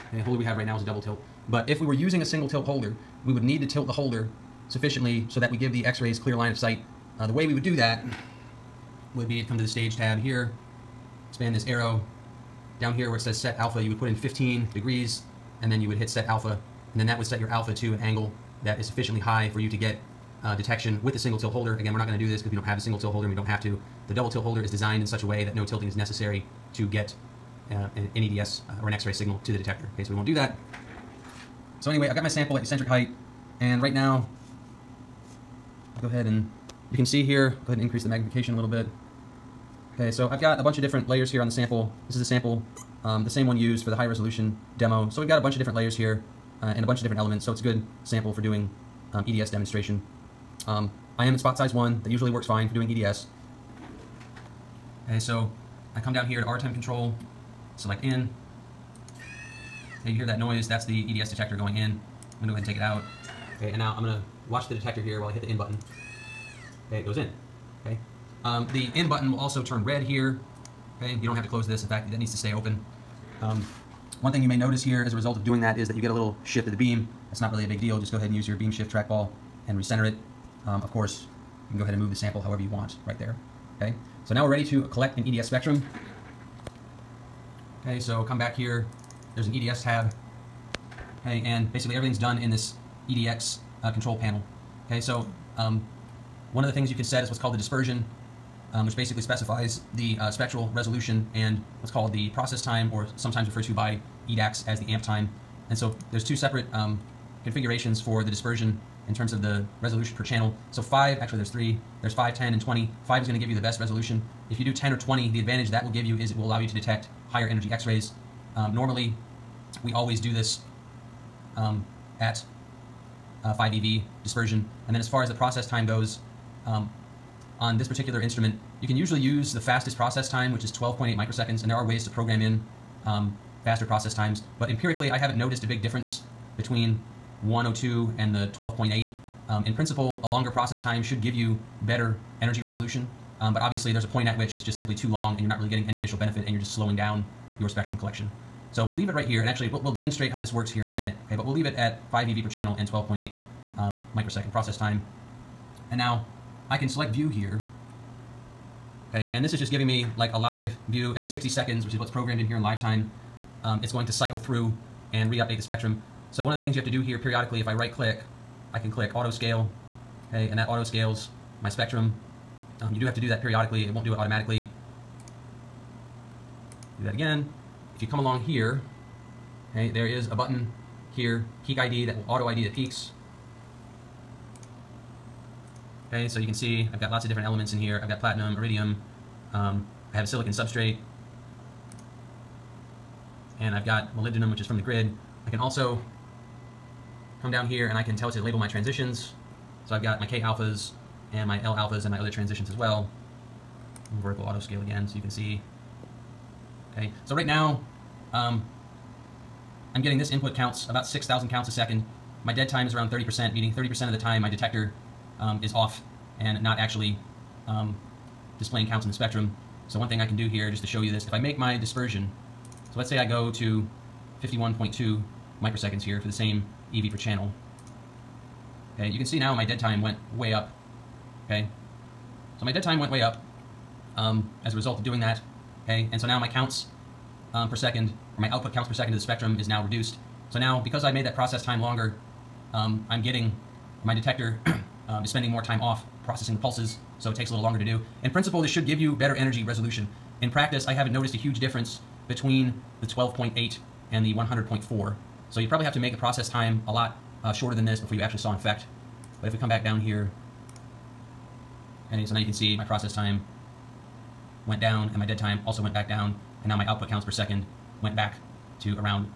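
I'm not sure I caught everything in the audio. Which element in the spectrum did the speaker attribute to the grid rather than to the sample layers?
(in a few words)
molybdenum.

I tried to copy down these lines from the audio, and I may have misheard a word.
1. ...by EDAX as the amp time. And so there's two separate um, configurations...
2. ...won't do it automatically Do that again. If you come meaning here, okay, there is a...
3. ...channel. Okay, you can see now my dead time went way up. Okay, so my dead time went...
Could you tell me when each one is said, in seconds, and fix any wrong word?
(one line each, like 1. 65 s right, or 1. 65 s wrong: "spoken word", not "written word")
1. 103 s right
2. 173 s wrong: "along", not "meaning"
3. 227 s right.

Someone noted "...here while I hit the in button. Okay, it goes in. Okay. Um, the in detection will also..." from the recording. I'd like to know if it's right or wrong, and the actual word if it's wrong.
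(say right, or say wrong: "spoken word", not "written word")
wrong: "button", not "detection".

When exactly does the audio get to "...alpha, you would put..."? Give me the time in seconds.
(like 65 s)
13 s.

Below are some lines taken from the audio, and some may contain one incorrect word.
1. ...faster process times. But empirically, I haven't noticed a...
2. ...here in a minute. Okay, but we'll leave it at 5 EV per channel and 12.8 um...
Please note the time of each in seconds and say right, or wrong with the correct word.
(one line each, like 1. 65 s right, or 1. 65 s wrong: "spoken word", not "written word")
1. 133 s right
2. 150 s right.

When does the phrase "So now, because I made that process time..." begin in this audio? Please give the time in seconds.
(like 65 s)
240 s.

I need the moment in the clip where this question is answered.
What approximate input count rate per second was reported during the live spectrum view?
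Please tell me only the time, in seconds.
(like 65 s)
211 s.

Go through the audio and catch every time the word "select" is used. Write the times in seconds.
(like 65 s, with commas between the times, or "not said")
57 s, 156 s.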